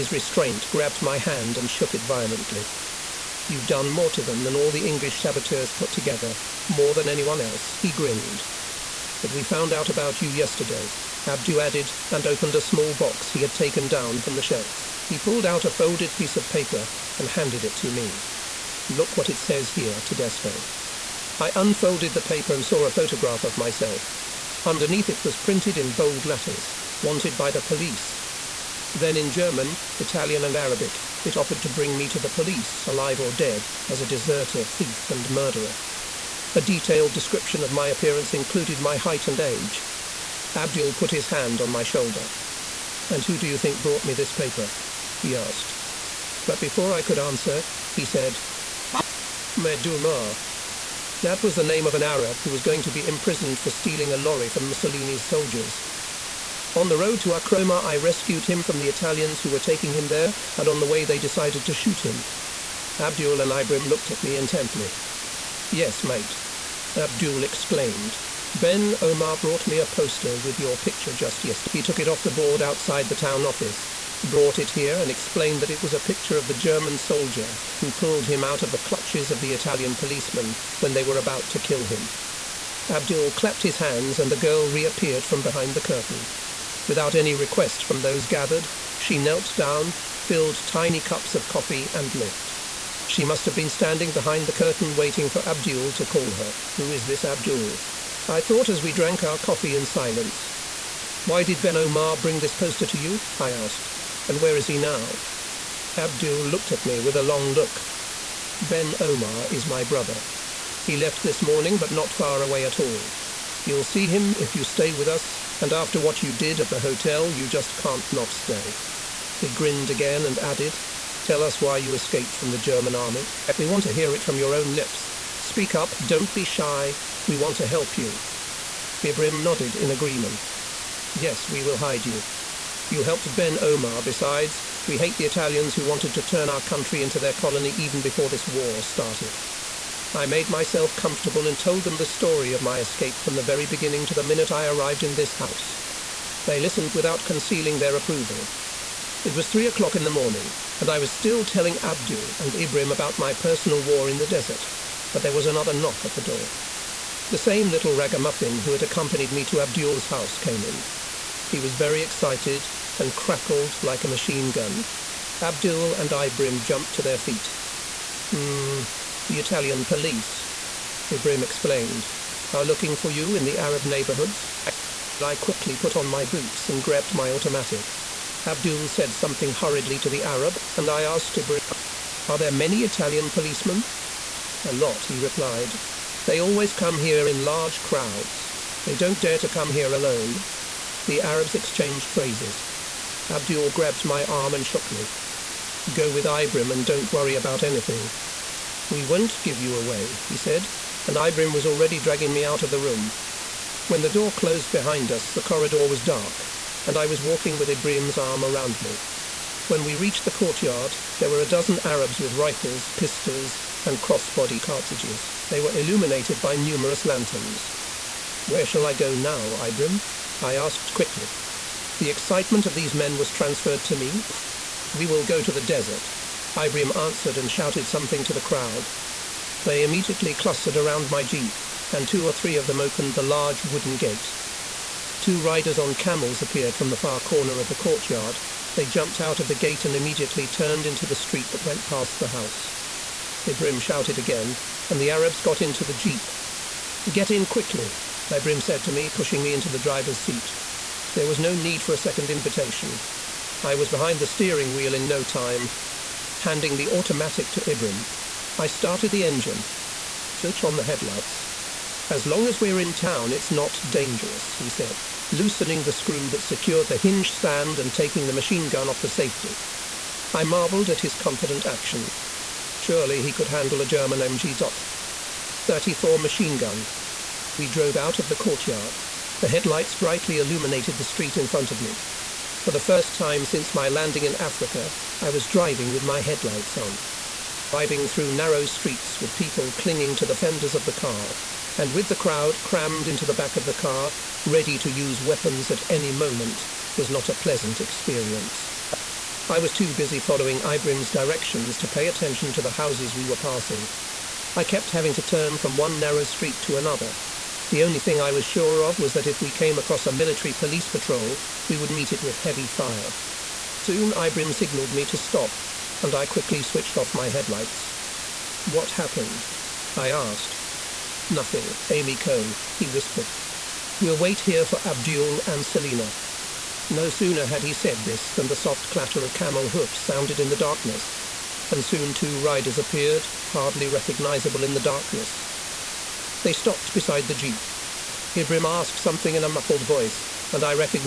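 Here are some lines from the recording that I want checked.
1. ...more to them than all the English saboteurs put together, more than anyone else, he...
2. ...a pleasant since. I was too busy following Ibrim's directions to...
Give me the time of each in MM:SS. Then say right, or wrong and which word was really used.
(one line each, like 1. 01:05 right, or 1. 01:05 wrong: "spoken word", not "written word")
1. 00:03 right
2. 04:57 wrong: "experience", not "since".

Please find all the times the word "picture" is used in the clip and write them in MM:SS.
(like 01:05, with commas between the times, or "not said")
01:10, 01:15.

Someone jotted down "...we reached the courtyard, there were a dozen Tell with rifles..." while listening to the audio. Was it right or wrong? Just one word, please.
wrong.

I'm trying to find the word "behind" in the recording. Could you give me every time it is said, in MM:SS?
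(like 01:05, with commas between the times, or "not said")
01:25, 01:34, 03:24, 04:13.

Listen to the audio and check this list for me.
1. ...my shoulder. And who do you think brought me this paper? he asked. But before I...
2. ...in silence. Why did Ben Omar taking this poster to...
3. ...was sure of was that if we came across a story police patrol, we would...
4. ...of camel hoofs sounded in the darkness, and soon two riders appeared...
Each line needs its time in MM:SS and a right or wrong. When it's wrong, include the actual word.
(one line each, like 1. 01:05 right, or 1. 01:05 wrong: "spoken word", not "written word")
1. 00:41 right
2. 01:39 wrong: "bring", not "taking"
3. 05:08 wrong: "military", not "story"
4. 05:29 right.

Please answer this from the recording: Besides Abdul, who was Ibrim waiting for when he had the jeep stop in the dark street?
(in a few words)
Selina.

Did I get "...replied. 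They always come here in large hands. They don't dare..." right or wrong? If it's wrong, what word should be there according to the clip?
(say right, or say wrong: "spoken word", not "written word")
wrong: "crowds", not "hands".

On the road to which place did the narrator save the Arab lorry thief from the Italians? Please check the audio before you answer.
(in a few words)
Acroma.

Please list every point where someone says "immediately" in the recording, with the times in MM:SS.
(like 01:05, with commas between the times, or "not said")
03:49, 03:59.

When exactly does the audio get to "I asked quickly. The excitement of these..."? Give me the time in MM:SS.
03:40.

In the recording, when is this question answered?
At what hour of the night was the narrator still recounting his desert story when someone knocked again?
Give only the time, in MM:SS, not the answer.
02:29.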